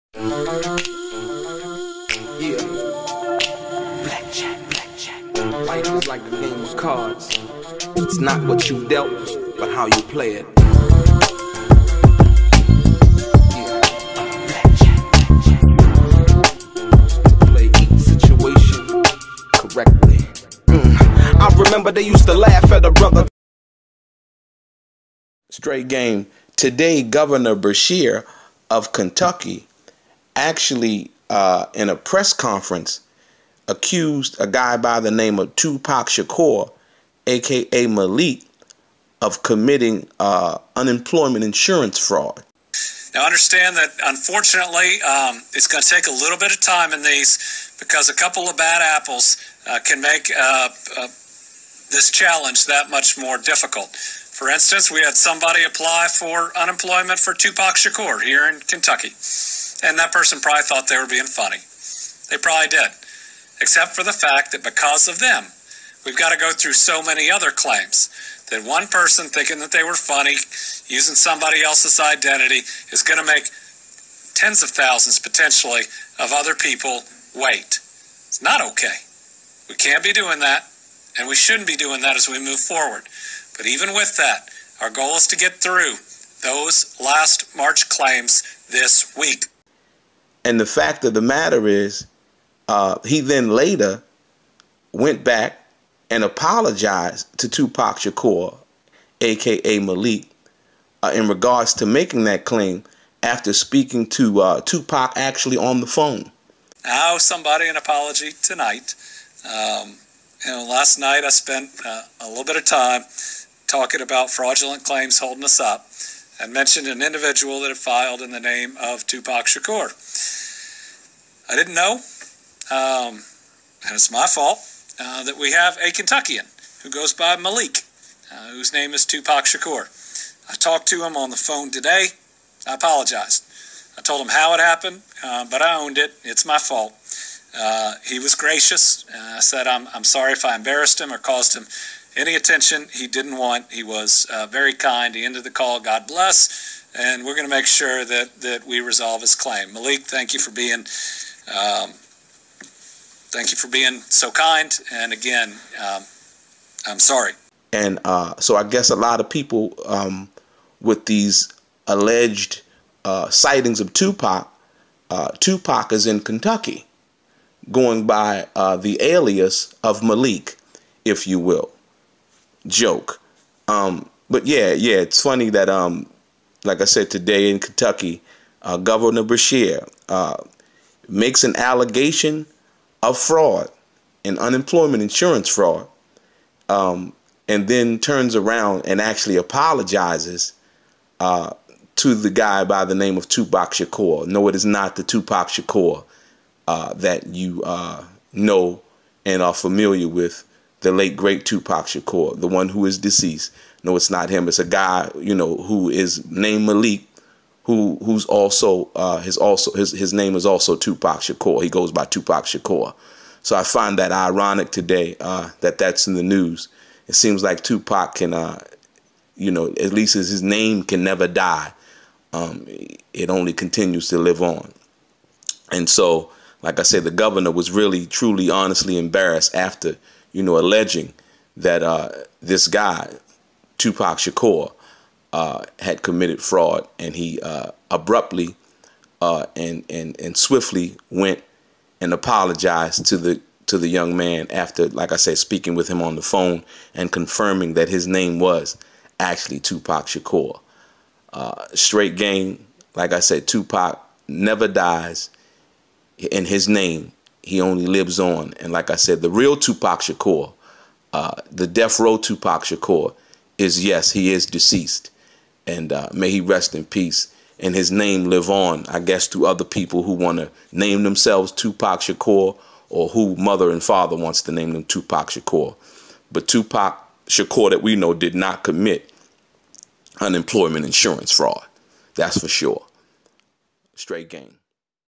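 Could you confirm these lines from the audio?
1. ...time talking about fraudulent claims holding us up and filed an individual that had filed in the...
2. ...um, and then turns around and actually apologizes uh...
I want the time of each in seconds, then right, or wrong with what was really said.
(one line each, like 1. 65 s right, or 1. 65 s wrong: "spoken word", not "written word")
1. 112 s wrong: "mentioned", not "filed"
2. 186 s right.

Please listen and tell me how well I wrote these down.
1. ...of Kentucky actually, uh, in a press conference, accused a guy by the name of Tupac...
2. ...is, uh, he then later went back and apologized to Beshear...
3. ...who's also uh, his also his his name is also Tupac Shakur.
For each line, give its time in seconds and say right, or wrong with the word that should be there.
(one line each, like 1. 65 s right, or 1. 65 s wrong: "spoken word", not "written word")
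1. 28 s right
2. 91 s wrong: "Tupac", not "Beshear"
3. 208 s right.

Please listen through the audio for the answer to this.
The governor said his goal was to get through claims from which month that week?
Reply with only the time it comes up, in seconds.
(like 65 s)
87 s.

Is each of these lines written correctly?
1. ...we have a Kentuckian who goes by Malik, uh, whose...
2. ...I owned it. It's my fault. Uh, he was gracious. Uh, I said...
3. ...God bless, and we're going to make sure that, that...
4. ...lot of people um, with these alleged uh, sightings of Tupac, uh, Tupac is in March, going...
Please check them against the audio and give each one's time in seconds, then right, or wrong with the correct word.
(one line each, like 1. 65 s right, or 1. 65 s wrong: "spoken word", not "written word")
1. 125 s right
2. 135 s right
3. 145 s right
4. 158 s wrong: "Kentucky", not "March".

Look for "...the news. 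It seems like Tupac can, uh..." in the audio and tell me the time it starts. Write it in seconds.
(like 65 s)
216 s.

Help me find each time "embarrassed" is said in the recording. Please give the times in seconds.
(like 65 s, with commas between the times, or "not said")
140 s, 228 s.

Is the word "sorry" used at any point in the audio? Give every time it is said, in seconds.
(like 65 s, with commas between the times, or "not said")
140 s, 156 s.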